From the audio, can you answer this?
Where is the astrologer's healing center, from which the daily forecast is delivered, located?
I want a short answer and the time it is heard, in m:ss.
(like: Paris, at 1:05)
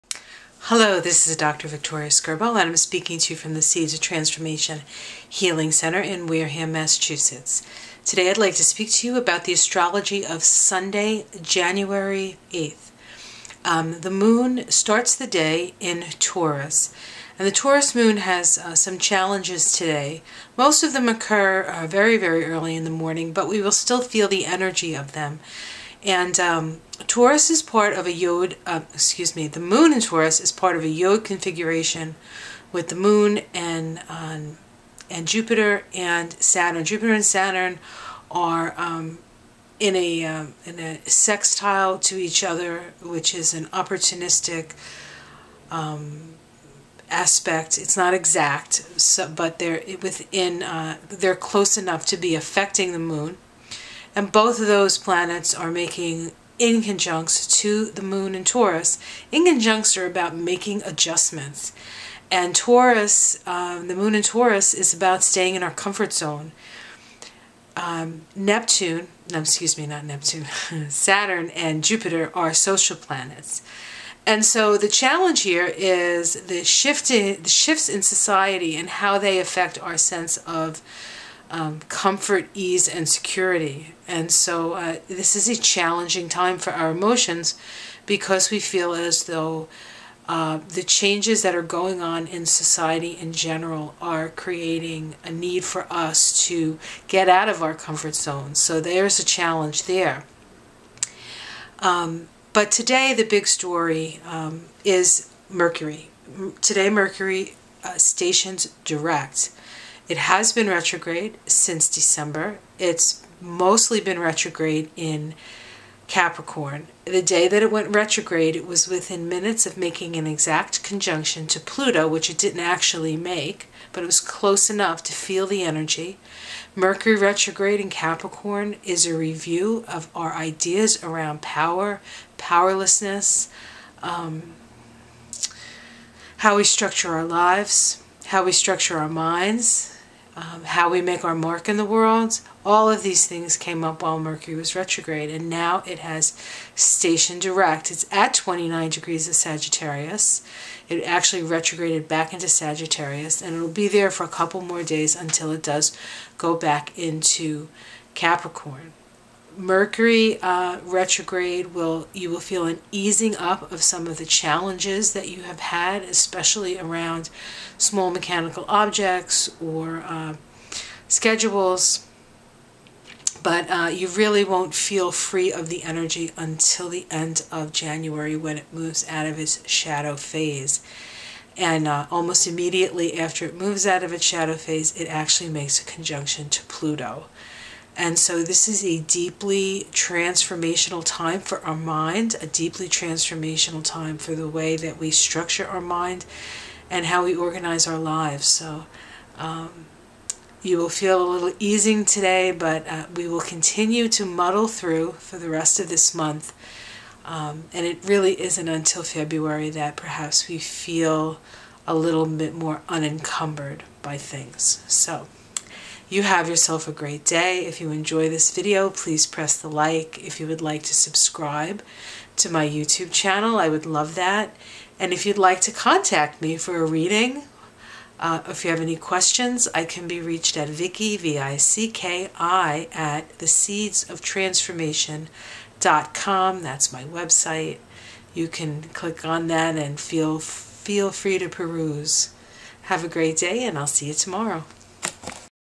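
Wareham, Massachusetts, at 0:06.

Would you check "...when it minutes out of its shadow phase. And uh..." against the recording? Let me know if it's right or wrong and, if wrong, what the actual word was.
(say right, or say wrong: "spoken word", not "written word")
wrong: "moves", not "minutes".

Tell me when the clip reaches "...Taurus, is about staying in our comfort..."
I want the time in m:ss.
1:04.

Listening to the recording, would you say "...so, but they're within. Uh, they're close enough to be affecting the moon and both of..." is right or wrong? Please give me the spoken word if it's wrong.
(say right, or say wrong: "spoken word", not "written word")
right.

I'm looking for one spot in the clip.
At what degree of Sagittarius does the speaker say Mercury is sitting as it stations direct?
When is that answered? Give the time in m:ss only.
2:28.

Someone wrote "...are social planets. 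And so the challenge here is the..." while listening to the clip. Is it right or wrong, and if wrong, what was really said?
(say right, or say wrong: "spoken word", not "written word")
right.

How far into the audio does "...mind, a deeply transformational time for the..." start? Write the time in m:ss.
3:11.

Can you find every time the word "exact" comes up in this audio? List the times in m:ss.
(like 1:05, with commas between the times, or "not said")
0:48, 2:00.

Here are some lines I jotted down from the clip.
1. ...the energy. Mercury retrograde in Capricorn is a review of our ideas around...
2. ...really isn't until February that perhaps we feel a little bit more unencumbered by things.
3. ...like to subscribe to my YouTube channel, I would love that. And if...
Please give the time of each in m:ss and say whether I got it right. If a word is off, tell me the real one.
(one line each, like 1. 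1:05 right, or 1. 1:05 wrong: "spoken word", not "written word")
1. 2:05 right
2. 3:28 right
3. 3:40 right.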